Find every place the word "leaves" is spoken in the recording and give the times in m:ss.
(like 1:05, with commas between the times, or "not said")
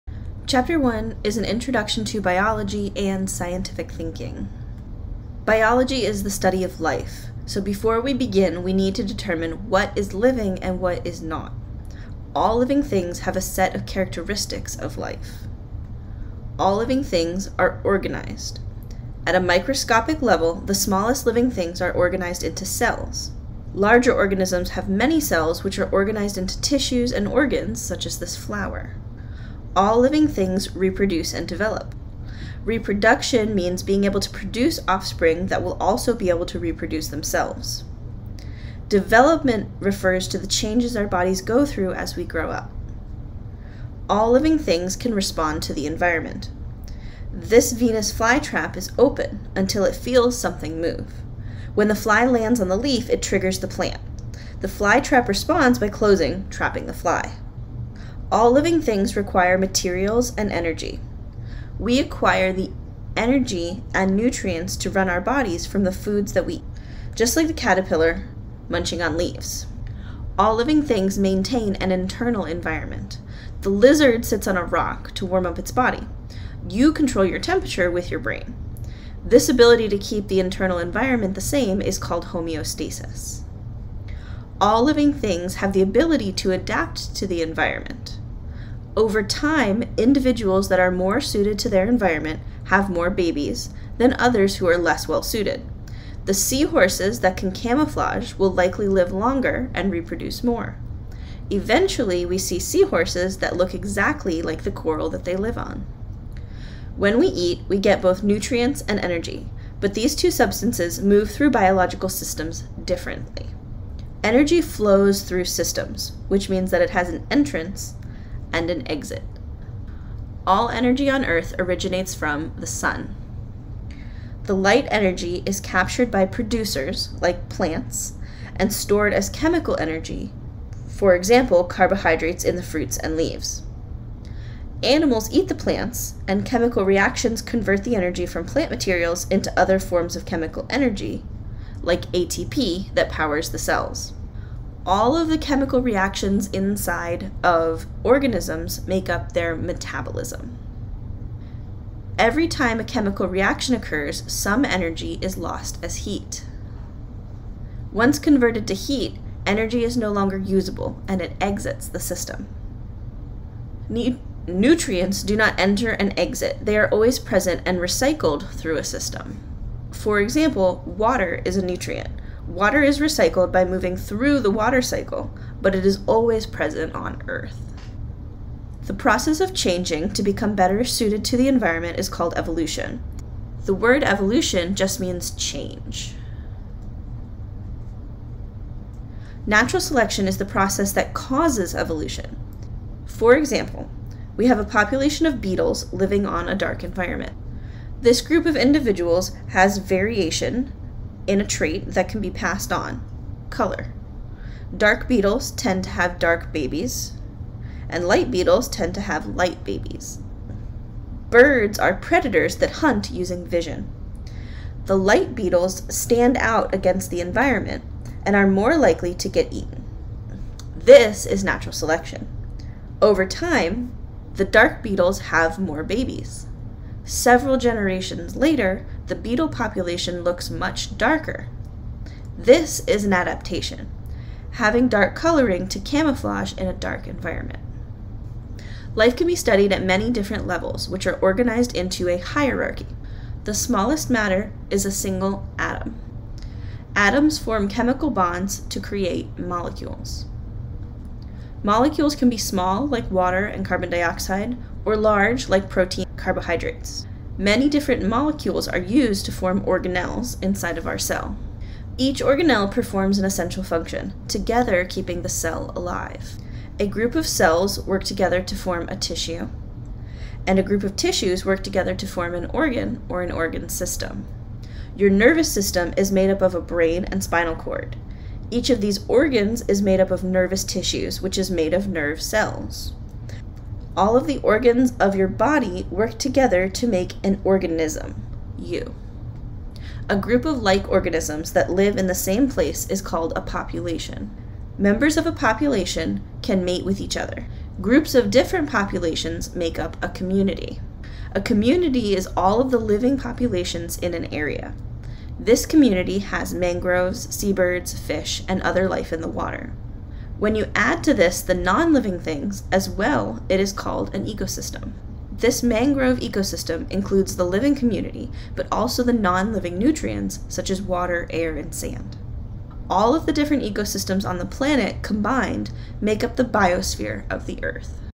1:09, 2:13.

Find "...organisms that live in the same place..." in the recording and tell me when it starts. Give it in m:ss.
4:50.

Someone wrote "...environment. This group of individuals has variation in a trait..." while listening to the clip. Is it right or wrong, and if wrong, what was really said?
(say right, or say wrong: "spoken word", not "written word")
right.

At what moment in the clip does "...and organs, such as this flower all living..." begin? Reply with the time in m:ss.
0:27.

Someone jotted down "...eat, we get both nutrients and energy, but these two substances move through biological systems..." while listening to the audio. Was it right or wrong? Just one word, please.
right.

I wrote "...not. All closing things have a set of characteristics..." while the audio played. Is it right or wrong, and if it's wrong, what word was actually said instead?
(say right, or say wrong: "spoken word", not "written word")
wrong: "living", not "closing".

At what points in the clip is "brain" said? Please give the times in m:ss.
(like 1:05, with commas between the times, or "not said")
1:18, 4:36.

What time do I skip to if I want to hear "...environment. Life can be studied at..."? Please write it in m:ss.
3:57.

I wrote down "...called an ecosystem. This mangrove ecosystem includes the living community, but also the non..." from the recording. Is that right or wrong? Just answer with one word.
right.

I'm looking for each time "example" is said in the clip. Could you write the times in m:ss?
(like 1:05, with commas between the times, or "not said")
2:11, 2:50, 3:13.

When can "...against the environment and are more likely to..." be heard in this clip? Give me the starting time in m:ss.
3:36.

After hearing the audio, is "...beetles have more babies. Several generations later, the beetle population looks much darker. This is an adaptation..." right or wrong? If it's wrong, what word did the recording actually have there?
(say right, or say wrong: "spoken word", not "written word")
right.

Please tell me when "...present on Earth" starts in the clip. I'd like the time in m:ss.
2:56.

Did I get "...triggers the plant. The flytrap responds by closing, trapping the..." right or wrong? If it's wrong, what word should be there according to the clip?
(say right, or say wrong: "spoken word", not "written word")
right.